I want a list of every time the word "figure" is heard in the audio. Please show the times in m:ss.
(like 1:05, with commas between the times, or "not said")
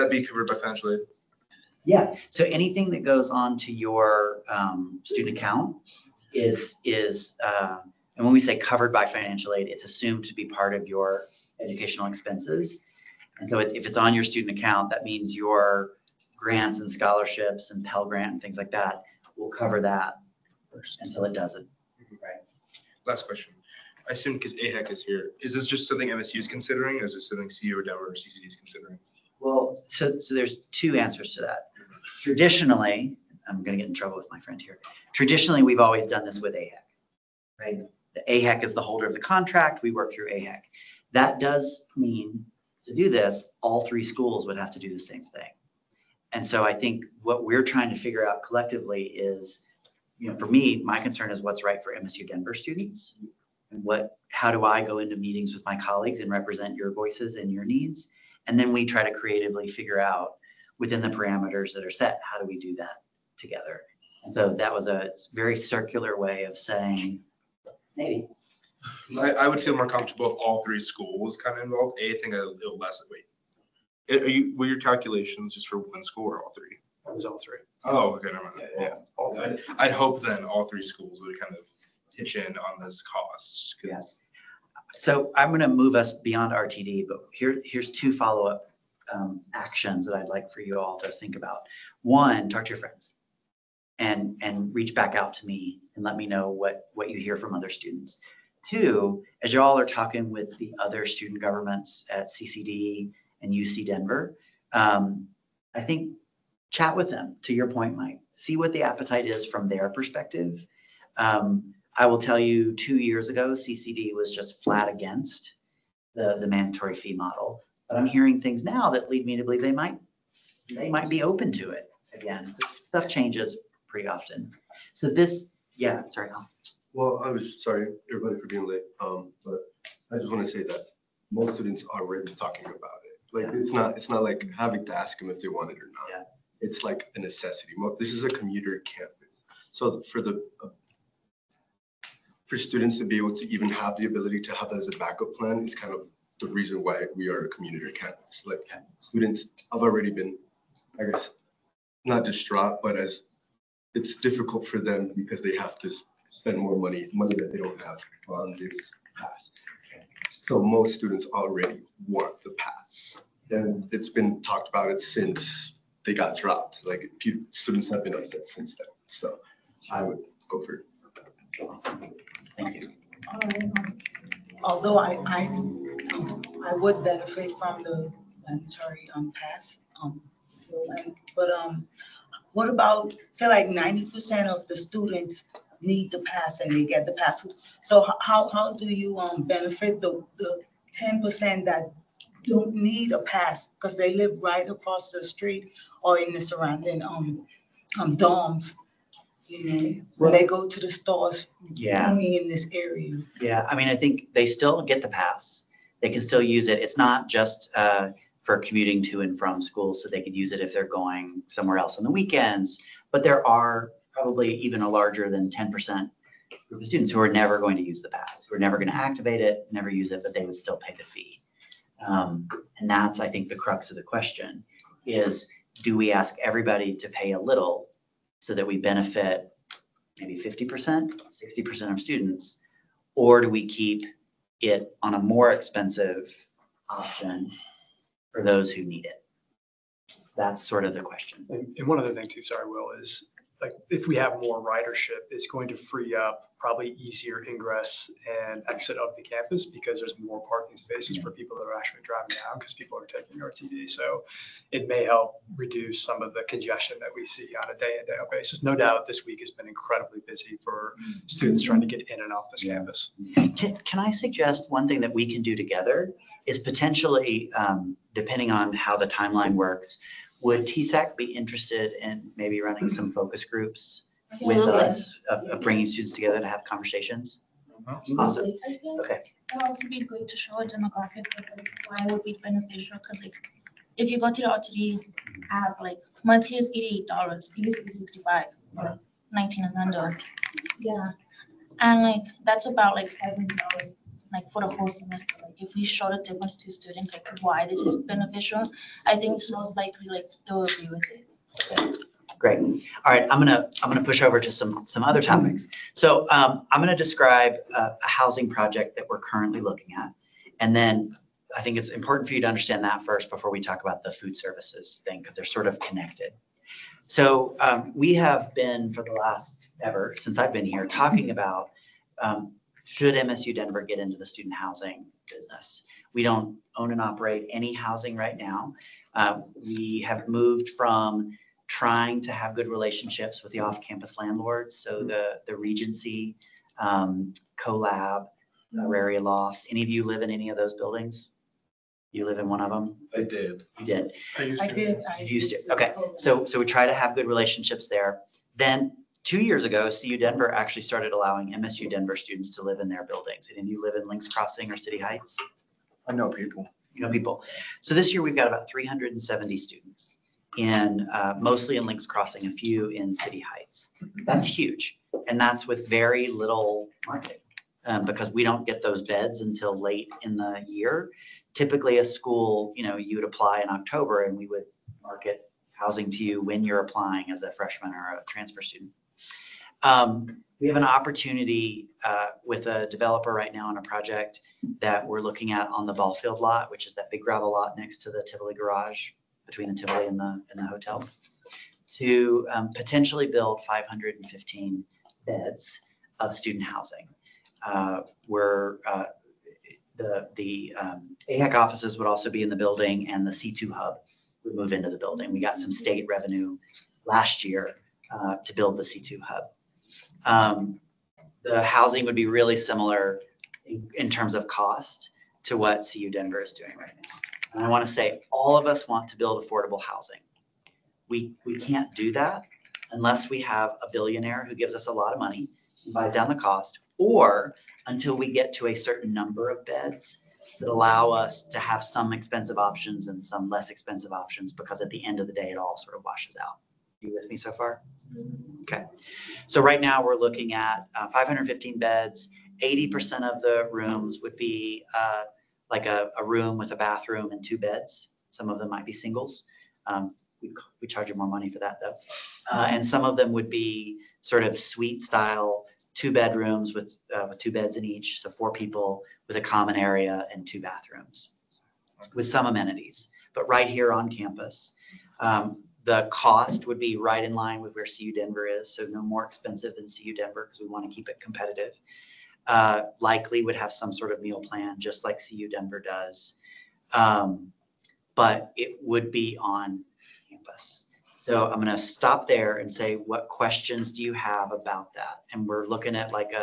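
0:47, 0:59.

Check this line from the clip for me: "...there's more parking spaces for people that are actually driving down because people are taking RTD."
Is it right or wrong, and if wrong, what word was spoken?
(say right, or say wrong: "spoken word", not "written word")
right.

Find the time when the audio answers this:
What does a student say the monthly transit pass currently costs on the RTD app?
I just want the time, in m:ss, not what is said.
4:46.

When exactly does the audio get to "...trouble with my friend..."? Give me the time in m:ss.
0:33.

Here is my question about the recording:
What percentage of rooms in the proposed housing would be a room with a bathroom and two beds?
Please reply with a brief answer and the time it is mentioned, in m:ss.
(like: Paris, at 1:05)
80%, at 7:22.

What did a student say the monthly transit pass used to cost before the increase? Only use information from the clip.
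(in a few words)
$65.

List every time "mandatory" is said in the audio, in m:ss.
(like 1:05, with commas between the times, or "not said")
1:56, 2:58.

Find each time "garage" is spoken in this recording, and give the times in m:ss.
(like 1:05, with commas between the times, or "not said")
6:28.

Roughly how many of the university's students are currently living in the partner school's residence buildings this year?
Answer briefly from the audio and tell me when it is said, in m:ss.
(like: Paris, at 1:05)
370, at 5:58.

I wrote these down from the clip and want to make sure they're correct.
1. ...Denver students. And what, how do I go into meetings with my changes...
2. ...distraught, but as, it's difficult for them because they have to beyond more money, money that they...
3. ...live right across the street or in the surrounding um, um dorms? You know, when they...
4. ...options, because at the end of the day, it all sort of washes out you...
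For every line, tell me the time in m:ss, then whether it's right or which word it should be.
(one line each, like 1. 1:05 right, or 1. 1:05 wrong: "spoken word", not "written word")
1. 0:52 wrong: "colleagues", not "changes"
2. 2:32 wrong: "spend", not "beyond"
3. 3:14 right
4. 7:14 right.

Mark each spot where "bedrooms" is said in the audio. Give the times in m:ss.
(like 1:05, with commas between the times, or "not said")
7:36.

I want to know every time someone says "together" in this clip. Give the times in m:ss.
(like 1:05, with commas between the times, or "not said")
1:03, 4:25, 4:36.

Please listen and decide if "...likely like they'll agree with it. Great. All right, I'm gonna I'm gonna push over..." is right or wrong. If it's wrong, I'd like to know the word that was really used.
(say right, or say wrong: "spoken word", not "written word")
right.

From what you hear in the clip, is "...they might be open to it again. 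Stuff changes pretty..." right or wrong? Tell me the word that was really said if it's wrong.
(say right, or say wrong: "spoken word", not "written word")
right.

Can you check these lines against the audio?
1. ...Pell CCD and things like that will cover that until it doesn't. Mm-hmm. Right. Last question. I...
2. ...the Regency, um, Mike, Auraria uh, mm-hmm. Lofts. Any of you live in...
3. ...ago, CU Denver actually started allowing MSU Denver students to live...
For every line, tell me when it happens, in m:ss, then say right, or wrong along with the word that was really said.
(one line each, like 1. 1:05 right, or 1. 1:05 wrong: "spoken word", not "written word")
1. 0:17 wrong: "Grant", not "CCD"
2. 5:35 wrong: "CoLab", not "Mike"
3. 5:49 right.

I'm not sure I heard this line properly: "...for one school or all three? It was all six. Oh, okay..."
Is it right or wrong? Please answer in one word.
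wrong.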